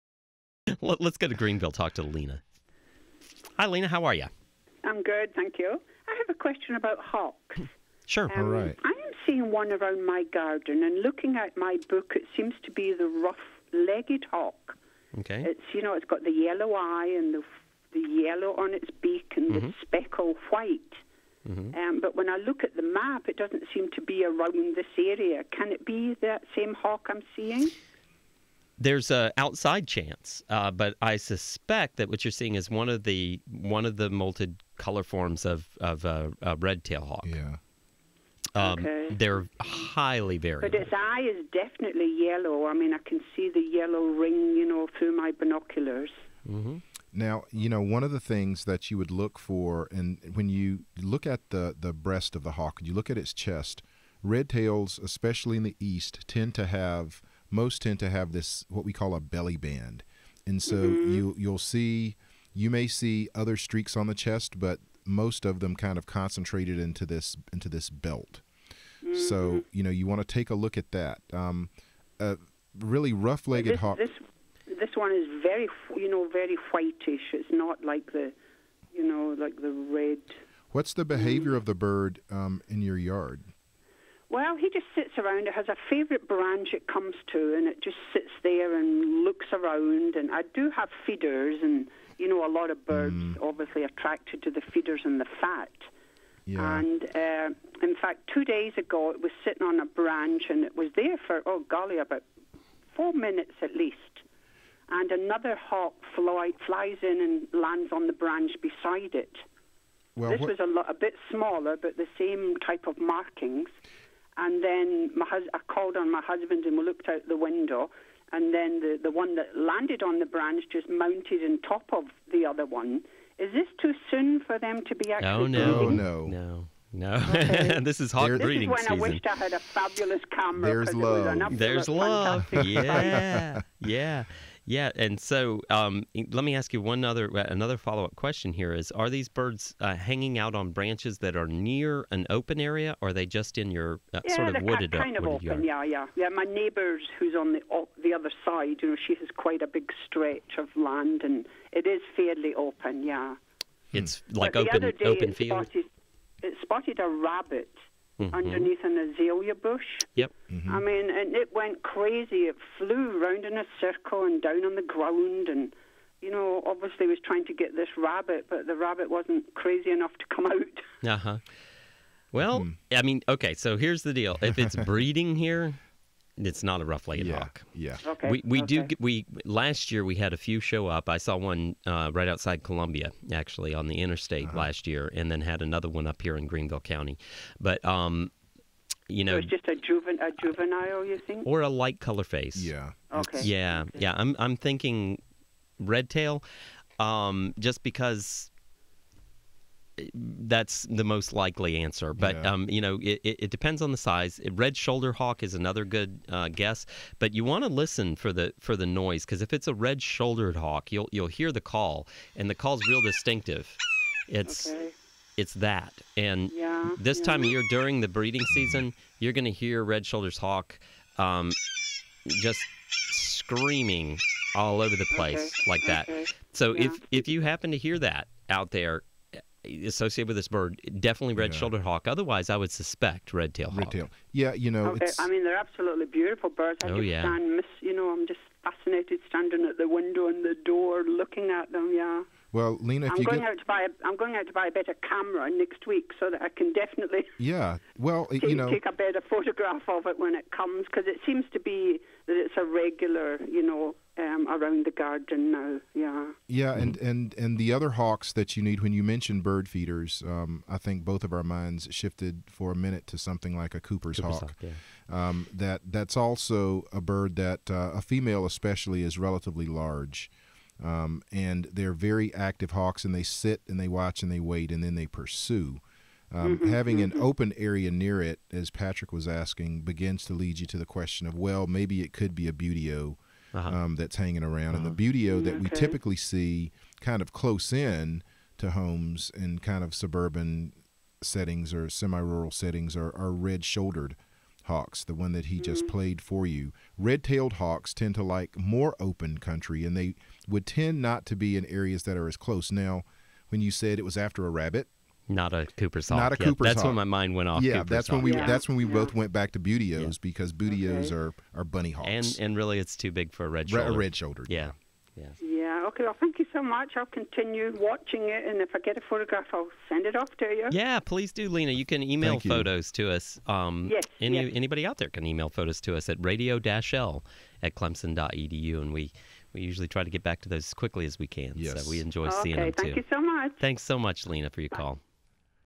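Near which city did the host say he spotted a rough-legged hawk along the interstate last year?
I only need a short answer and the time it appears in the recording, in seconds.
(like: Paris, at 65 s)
Columbia, at 182 s.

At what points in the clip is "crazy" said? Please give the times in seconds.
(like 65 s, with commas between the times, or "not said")
161 s, 169 s.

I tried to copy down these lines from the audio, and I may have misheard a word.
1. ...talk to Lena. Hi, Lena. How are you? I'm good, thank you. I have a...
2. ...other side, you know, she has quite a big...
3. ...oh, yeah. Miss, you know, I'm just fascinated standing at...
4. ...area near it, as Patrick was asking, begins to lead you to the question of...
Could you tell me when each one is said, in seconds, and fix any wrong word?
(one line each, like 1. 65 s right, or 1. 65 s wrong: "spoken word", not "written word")
1. 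1 s right
2. 148 s right
3. 236 s right
4. 277 s right.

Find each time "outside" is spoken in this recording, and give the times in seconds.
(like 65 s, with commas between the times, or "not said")
29 s, 182 s.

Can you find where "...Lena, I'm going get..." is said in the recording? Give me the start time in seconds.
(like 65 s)
242 s.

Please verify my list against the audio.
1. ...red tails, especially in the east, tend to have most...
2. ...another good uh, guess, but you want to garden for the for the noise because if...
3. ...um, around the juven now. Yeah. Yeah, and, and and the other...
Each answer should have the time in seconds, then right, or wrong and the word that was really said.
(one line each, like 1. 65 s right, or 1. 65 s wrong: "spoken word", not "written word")
1. 54 s right
2. 205 s wrong: "listen", not "garden"
3. 254 s wrong: "garden", not "juven".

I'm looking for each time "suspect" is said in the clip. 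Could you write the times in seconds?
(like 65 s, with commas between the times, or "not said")
31 s, 232 s.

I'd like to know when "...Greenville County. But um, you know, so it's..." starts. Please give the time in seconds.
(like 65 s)
186 s.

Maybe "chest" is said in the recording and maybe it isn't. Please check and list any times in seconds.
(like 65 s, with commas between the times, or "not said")
53 s, 64 s.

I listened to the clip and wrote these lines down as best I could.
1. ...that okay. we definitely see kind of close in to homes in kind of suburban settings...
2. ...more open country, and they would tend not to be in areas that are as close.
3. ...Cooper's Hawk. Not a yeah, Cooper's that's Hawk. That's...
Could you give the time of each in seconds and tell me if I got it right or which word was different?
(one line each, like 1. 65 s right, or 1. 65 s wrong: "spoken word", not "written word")
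1. 285 s wrong: "typically", not "definitely"
2. 298 s right
3. 305 s right.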